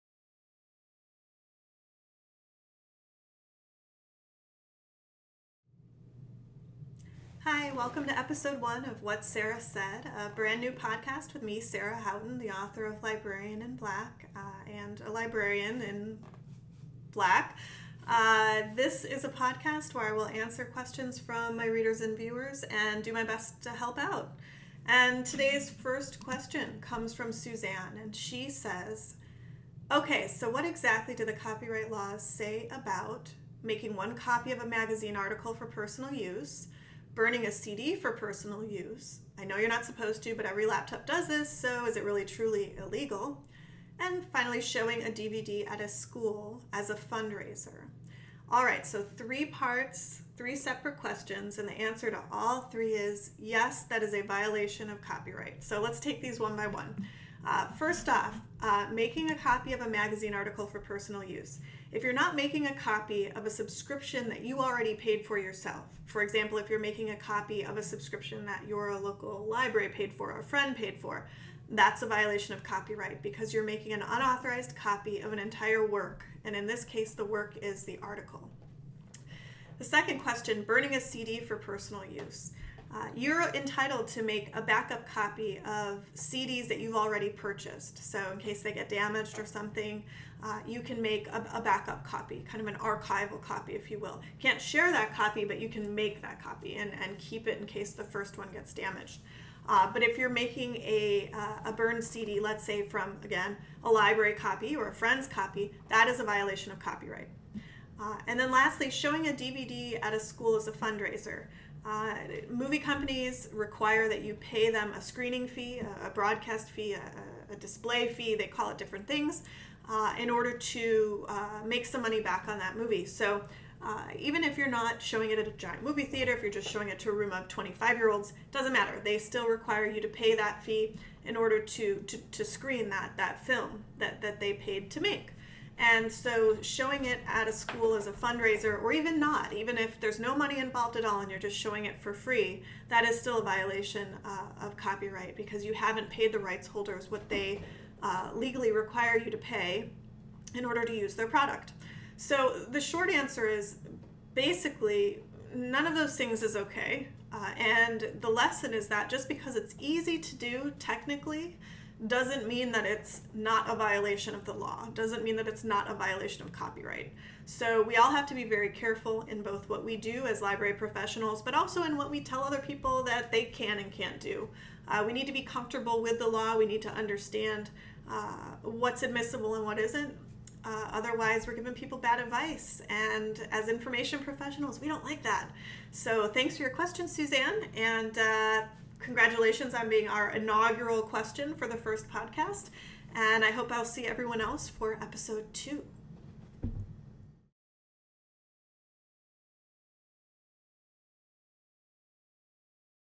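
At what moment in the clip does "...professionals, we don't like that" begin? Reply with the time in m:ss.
3:04.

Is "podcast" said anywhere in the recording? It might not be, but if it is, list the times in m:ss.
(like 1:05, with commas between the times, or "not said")
0:10, 0:19, 3:12.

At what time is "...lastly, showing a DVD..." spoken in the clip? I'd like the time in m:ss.
1:48.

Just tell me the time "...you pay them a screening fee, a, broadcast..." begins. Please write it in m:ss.
1:54.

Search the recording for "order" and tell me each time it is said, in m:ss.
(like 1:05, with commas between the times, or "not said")
2:00, 2:11, 2:30.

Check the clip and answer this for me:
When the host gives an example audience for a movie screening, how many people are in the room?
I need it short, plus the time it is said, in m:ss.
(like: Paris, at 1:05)
25, at 2:07.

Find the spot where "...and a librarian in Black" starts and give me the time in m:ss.
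0:14.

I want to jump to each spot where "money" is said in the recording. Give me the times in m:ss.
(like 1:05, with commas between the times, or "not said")
2:02, 2:20.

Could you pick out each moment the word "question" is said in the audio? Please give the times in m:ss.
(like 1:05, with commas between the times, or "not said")
0:20, 0:26, 0:50, 1:20, 3:06, 3:11.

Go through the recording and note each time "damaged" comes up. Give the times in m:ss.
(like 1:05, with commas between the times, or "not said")
1:28, 1:38.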